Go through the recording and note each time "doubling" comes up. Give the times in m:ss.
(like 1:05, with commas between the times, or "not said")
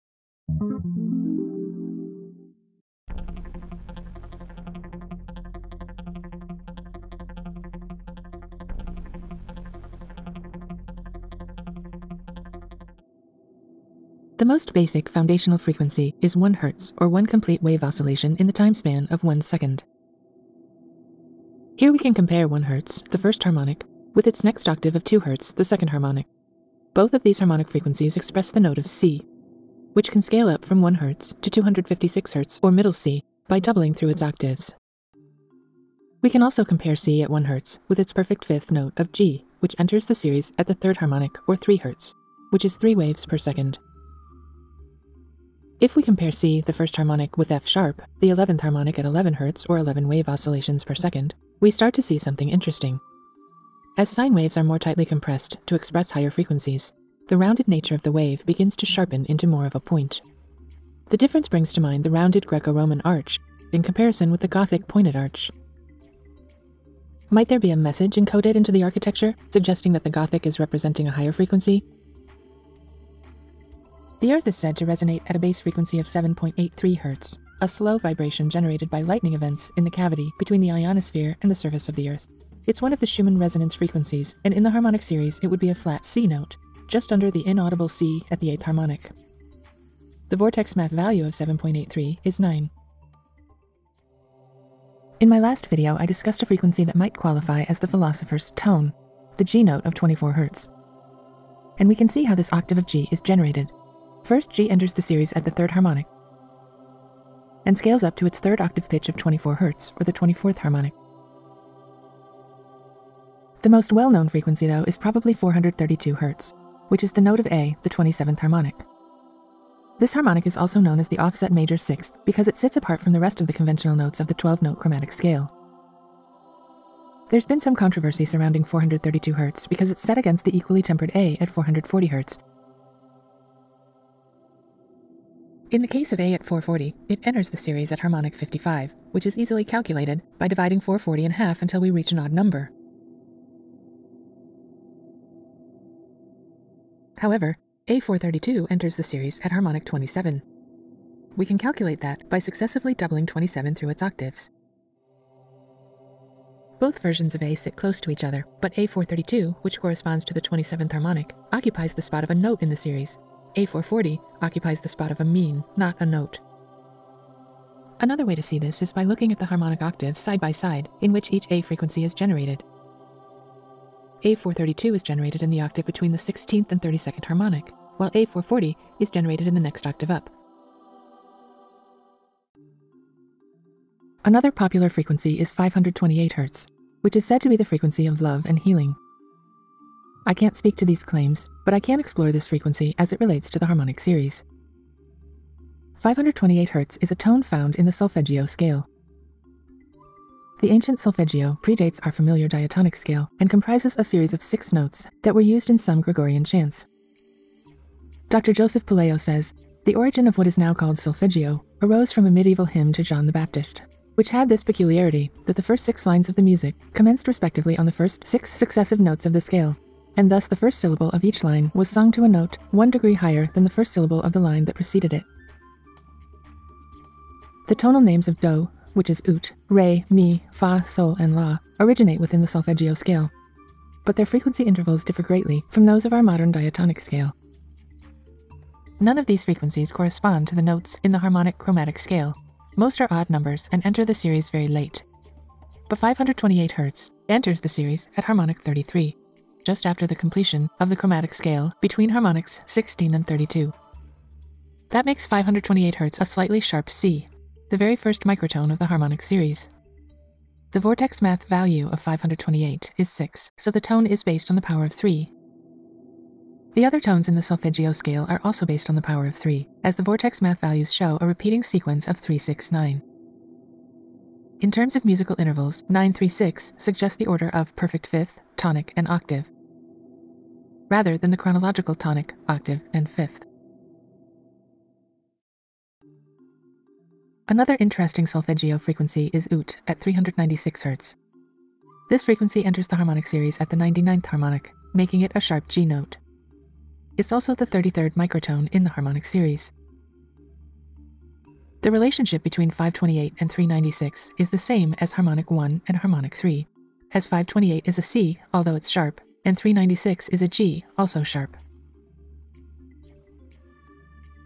0:33, 2:32.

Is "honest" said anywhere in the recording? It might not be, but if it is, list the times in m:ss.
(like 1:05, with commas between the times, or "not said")
not said.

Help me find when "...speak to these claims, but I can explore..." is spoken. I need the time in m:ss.
3:10.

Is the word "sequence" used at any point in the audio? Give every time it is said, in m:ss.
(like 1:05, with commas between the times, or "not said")
4:31.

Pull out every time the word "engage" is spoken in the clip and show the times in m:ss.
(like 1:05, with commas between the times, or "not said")
not said.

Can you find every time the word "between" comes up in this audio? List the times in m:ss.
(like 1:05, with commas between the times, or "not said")
1:20, 2:55, 4:11, 5:02.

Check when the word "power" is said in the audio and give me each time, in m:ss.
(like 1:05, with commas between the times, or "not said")
4:24, 4:29.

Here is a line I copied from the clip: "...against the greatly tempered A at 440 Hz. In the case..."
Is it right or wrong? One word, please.
wrong.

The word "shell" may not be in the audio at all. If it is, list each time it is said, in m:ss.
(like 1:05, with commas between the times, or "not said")
not said.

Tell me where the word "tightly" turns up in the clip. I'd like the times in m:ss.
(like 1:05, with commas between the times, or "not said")
0:54.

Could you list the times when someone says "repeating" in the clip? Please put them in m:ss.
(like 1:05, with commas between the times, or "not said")
4:31.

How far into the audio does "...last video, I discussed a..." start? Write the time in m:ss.
1:35.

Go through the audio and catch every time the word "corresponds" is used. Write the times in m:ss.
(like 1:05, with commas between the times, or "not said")
2:39, 3:59.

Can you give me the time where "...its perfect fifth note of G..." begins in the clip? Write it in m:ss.
0:37.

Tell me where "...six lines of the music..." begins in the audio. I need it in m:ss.
3:35.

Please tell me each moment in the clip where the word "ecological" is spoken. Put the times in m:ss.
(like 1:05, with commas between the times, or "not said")
not said.